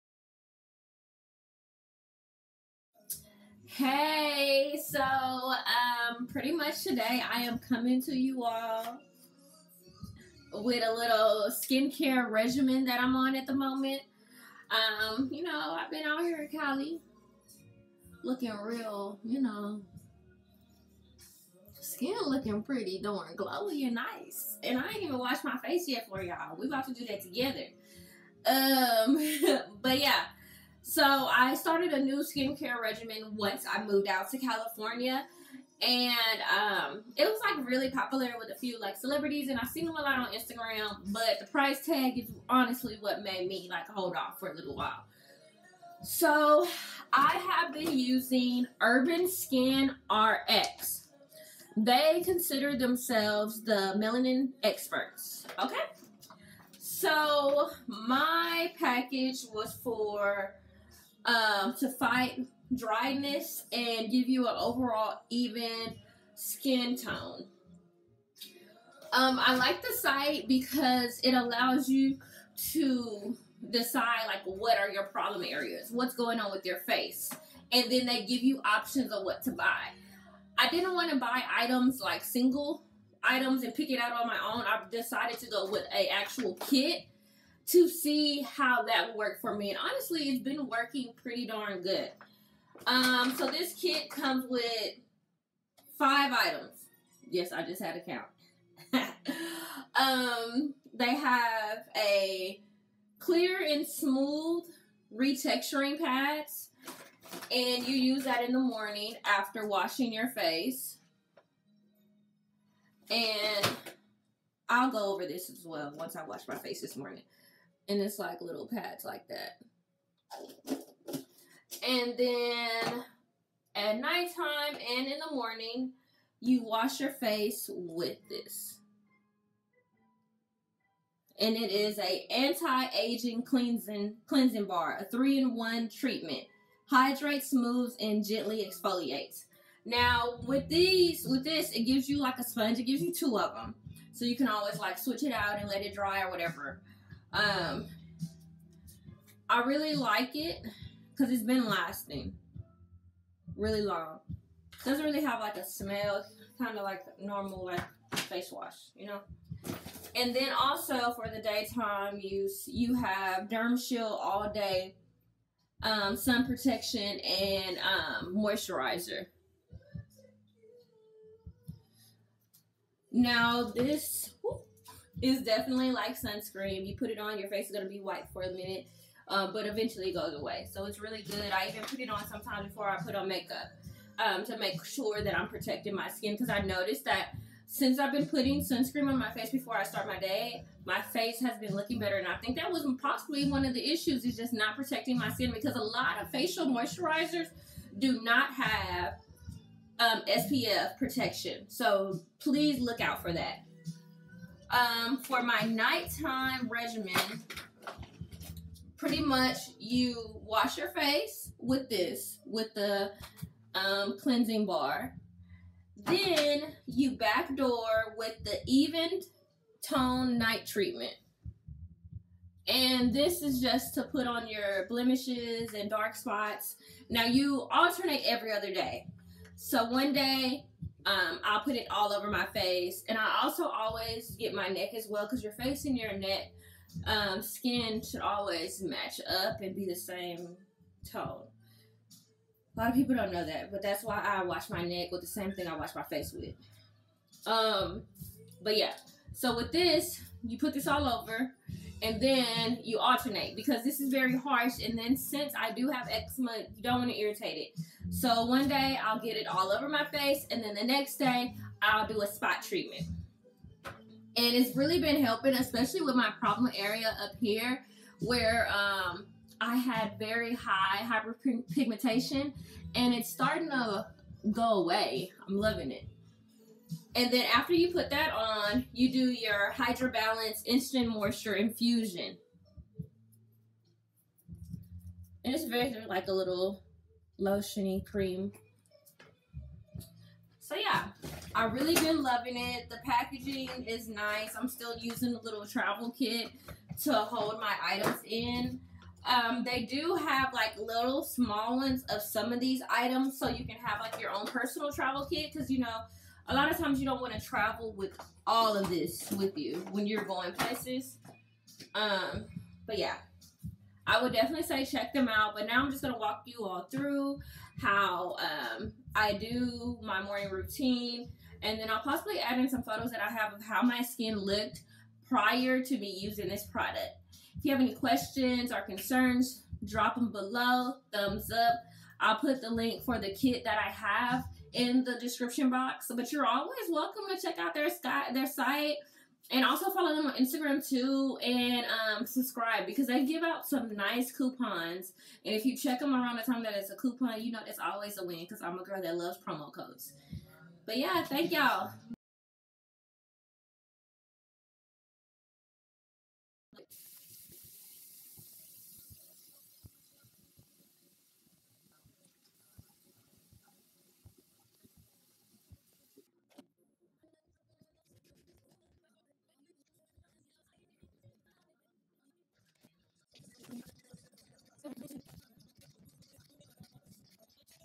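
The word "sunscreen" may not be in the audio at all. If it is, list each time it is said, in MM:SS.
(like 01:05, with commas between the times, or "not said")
02:56, 03:08.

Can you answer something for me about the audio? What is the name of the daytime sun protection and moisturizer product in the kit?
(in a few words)
Derm Shield.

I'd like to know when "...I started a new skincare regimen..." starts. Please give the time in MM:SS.
00:31.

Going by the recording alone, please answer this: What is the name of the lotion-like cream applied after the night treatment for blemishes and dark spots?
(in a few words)
Hydro Balance Instant Moisture Infusion.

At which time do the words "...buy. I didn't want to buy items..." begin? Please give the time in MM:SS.
01:19.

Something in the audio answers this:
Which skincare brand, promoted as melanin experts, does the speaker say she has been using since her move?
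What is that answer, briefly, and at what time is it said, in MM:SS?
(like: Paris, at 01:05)
Urban Skin RX, at 00:48.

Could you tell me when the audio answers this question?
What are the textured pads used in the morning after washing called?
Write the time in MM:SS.
01:43.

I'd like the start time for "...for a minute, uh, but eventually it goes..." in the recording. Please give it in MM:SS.
02:58.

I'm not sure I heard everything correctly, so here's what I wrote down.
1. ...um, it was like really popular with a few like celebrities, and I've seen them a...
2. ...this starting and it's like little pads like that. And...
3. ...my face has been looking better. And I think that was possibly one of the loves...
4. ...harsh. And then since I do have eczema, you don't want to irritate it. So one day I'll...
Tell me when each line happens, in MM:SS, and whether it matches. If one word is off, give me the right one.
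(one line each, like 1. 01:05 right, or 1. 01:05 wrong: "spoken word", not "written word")
1. 00:36 right
2. 01:56 wrong: "morning", not "starting"
3. 03:10 wrong: "issues", not "loves"
4. 04:14 right.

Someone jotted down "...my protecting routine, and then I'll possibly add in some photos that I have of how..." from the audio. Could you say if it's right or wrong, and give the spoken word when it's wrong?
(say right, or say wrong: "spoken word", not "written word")
wrong: "morning", not "protecting".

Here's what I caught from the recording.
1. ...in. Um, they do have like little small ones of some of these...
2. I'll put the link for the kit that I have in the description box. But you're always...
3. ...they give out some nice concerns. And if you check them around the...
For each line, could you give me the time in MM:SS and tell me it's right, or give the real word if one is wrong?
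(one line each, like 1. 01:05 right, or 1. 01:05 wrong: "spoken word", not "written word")
1. 04:58 right
2. 05:32 right
3. 05:43 wrong: "coupons", not "concerns".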